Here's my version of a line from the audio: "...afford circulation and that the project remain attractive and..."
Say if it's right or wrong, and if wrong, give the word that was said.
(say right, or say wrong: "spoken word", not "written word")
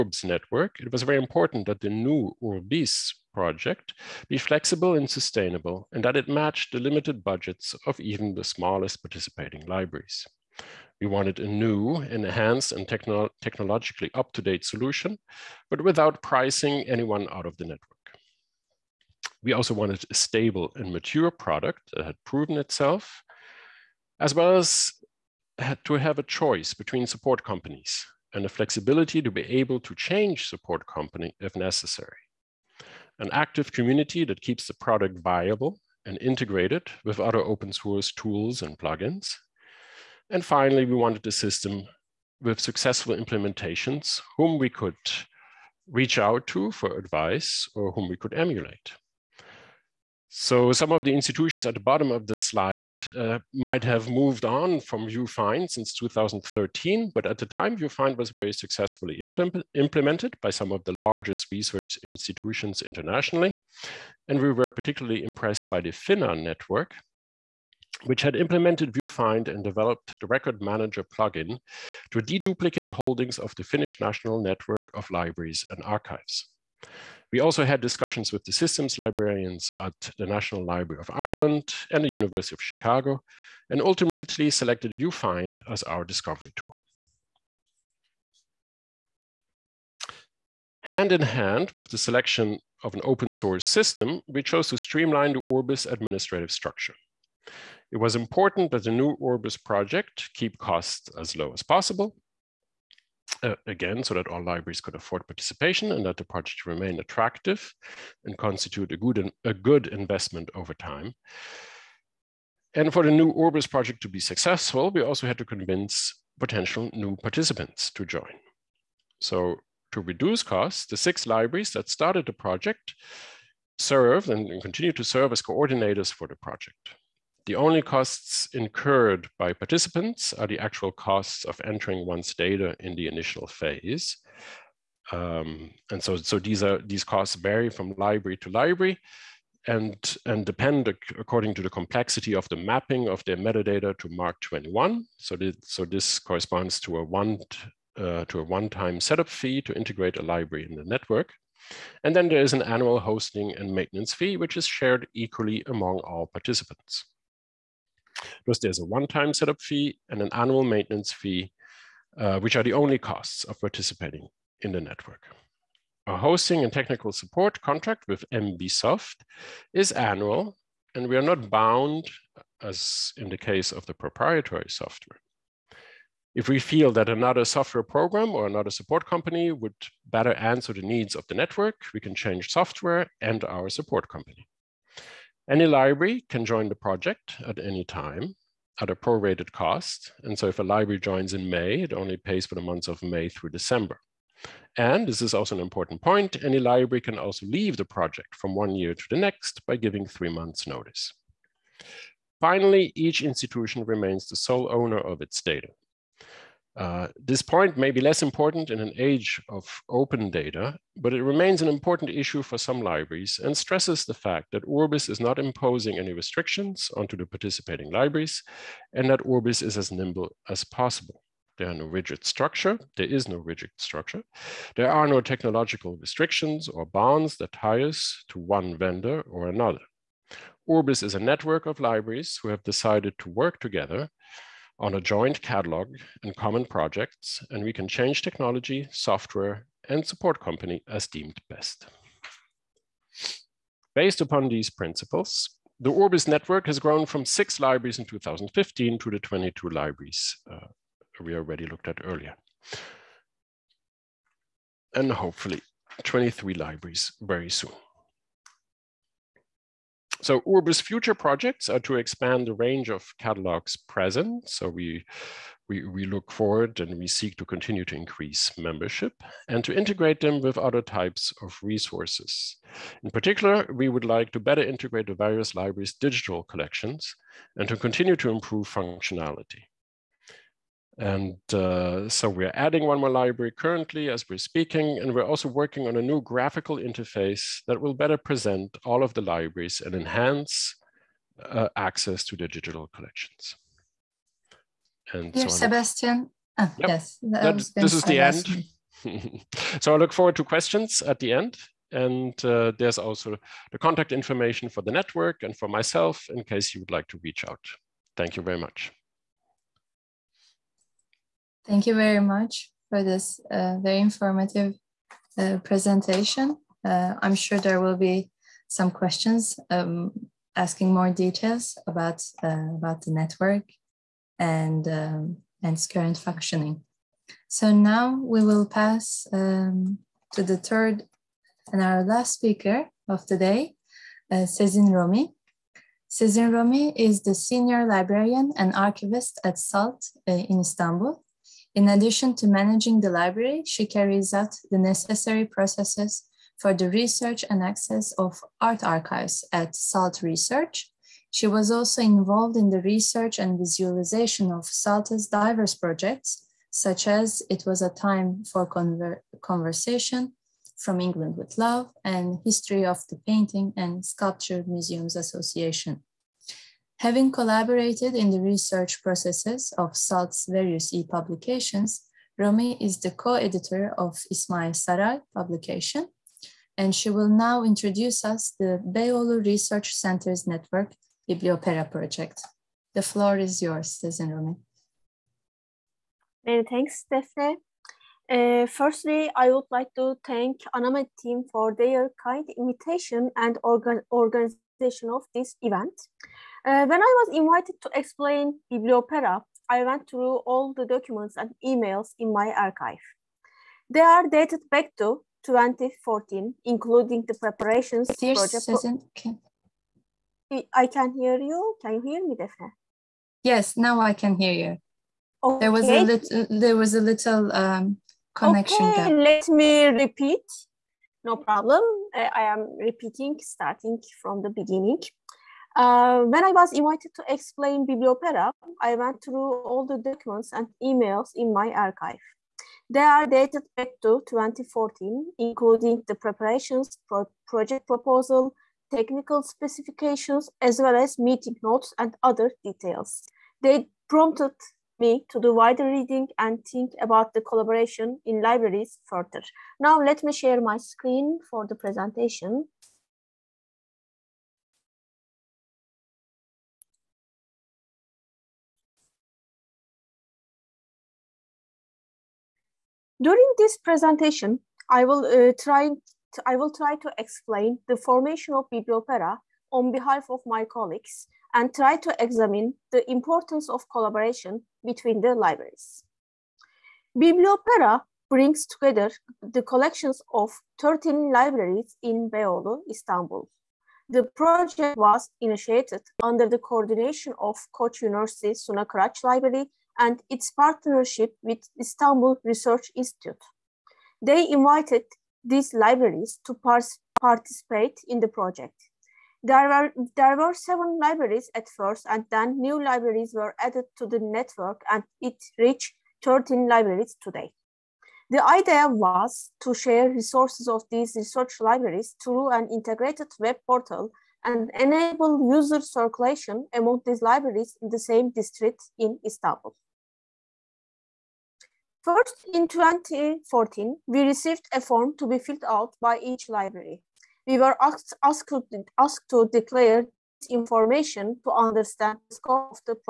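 wrong: "participation", not "circulation".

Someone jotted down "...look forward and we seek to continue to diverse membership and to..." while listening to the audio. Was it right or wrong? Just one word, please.
wrong.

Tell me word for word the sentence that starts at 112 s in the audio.
And for the new Urbis project to be successful, we also had to convince potential new participants to join.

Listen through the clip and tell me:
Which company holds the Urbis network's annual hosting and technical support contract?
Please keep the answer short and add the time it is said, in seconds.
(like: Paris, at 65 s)
MBSoft, at 168 s.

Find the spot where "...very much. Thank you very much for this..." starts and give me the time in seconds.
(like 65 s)
308 s.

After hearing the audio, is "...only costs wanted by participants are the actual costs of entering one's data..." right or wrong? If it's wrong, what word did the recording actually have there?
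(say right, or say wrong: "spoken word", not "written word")
wrong: "incurred", not "wanted".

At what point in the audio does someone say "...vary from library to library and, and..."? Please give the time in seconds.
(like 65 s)
137 s.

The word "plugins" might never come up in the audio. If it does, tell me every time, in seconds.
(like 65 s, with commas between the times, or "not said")
38 s, 71 s.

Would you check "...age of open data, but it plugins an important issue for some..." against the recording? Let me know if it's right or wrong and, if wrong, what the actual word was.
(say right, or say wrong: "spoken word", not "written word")
wrong: "remains", not "plugins".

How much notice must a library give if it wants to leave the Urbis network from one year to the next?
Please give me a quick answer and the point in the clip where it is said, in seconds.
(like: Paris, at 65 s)
3 months, at 200 s.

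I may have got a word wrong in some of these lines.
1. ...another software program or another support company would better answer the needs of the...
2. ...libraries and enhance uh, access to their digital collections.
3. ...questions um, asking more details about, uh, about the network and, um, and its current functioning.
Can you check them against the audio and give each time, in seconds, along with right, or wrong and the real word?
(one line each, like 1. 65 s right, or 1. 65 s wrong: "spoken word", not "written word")
1. 177 s right
2. 289 s right
3. 318 s right.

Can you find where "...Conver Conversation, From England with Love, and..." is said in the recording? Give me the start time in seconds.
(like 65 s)
358 s.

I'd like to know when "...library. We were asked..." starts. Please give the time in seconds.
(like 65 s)
526 s.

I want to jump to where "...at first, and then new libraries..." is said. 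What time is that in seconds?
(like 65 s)
501 s.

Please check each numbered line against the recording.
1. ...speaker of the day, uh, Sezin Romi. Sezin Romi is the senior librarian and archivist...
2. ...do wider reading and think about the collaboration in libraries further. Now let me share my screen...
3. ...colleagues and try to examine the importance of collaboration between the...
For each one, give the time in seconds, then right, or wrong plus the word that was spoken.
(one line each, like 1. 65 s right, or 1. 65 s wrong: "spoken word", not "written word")
1. 332 s right
2. 445 s right
3. 470 s right.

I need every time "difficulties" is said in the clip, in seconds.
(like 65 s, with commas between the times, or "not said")
not said.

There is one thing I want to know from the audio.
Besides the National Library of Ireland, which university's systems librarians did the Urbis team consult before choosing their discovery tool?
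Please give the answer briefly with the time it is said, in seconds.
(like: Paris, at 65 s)
University of Chicago, at 82 s.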